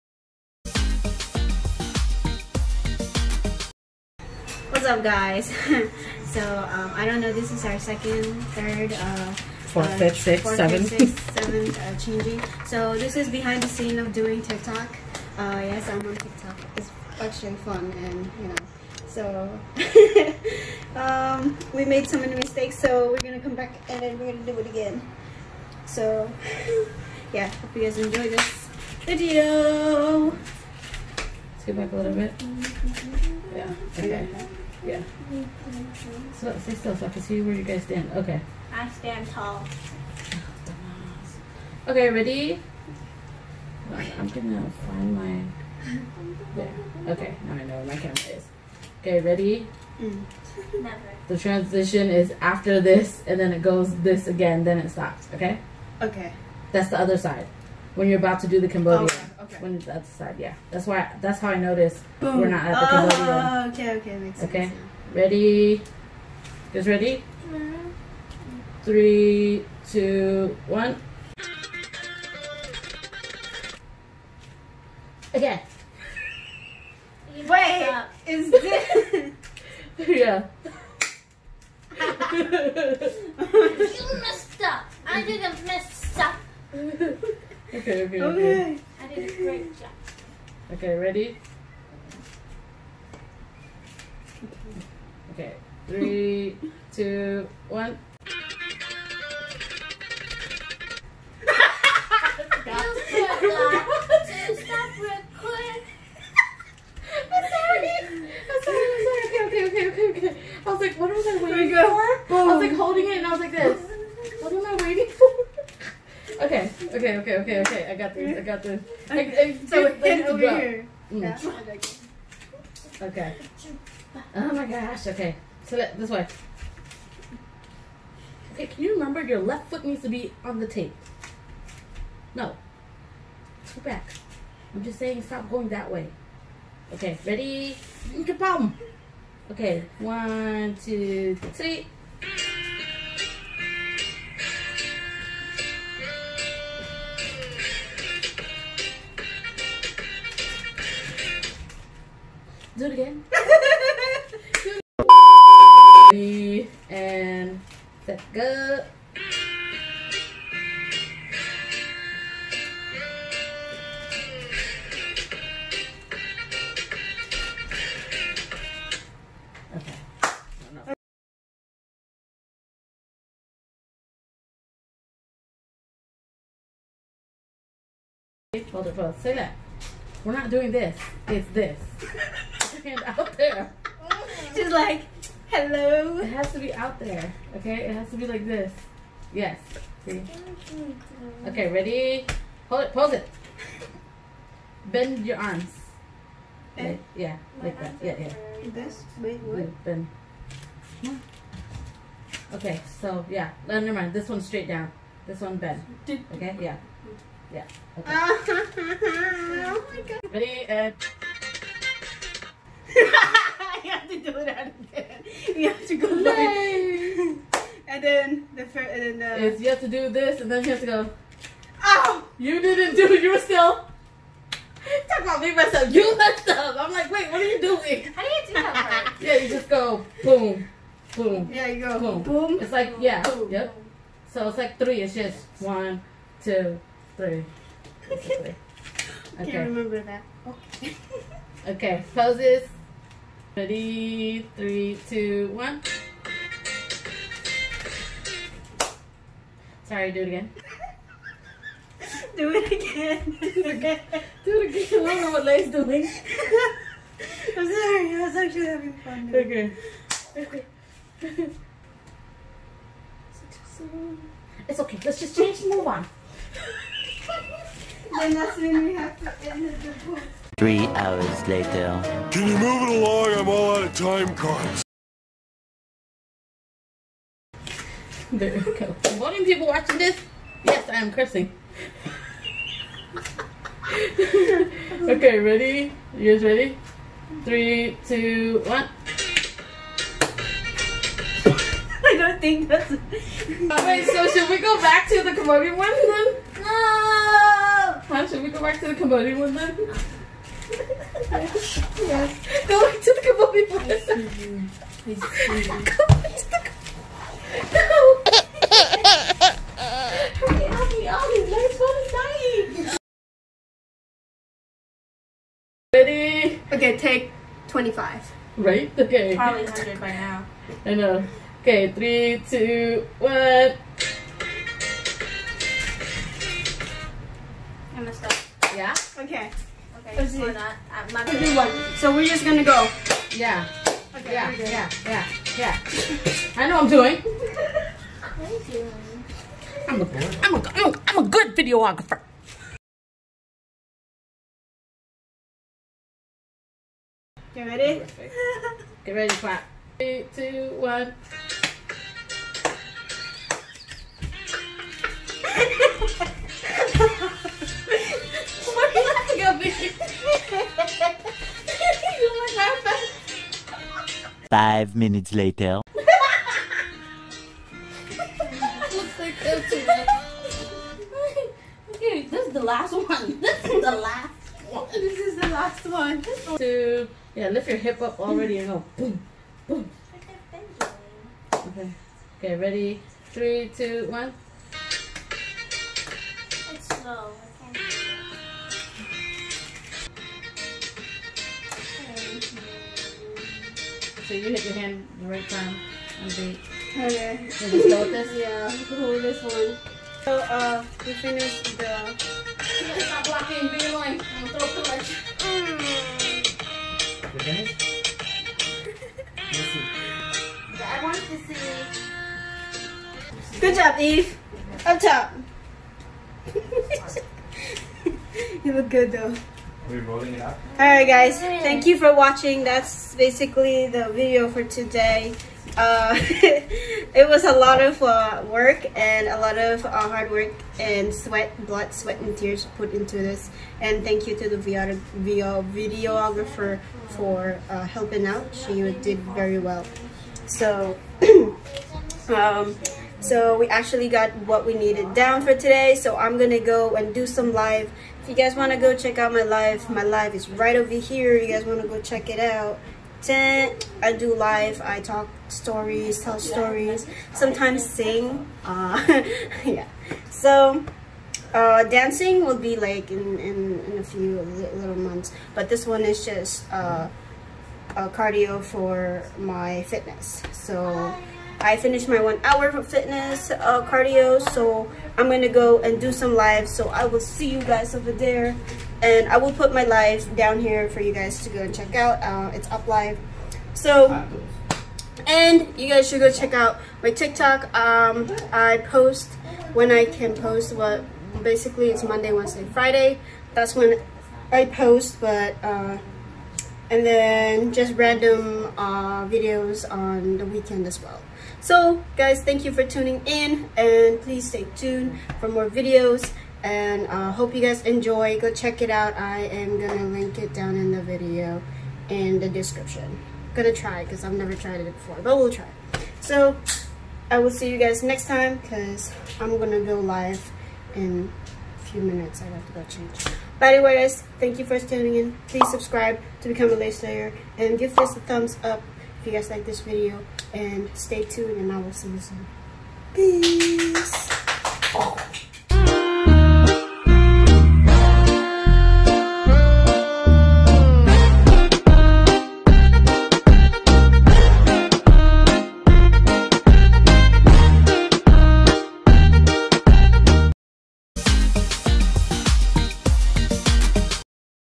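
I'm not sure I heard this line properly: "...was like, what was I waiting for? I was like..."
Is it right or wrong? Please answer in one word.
right.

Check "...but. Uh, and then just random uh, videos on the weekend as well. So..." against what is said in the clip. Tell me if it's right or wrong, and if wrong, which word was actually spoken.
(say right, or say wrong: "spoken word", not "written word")
right.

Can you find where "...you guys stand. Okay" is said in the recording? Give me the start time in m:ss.
0:37.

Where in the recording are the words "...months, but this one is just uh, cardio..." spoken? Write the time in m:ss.
7:44.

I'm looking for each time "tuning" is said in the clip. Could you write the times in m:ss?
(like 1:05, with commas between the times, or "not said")
8:22, 8:44.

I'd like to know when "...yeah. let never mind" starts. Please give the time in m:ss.
3:23.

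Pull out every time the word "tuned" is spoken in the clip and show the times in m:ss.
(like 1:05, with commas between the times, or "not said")
8:24, 8:51.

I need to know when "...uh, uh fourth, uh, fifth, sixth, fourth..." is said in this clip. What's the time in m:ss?
0:08.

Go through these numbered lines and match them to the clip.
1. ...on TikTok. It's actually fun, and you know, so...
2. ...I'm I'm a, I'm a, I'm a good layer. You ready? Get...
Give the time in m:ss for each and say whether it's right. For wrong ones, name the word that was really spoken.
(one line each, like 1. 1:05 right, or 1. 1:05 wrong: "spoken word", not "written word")
1. 0:16 right
2. 5:39 wrong: "videographer", not "layer".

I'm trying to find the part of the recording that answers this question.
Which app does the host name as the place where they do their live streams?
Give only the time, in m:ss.
8:02.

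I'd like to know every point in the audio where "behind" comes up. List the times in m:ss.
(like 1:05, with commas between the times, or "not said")
0:13.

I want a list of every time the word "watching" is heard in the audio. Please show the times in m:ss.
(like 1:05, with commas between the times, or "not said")
4:39, 7:02.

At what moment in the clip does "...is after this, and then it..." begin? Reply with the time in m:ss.
0:52.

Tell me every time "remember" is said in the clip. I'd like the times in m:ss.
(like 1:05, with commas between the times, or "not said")
2:08, 3:59.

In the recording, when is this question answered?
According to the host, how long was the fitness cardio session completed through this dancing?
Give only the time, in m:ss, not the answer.
7:52.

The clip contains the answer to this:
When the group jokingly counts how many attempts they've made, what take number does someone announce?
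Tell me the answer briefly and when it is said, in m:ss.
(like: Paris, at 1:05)
25, at 5:16.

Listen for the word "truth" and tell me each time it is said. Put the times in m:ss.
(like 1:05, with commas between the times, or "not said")
not said.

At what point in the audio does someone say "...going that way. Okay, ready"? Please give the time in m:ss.
2:15.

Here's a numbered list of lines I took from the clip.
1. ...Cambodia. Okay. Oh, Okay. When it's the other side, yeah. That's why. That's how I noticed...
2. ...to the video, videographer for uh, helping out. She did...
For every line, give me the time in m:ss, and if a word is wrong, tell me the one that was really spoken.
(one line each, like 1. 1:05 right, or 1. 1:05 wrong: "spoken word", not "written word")
1. 0:58 right
2. 7:14 right.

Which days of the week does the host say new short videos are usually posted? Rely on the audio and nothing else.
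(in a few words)
Monday, Wednesday, Friday.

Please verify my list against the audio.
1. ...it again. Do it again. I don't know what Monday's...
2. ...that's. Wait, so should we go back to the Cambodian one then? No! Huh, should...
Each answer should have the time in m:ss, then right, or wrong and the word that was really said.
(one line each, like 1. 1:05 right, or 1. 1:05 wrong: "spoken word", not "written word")
1. 4:13 wrong: "Lay", not "Monday"
2. 4:52 right.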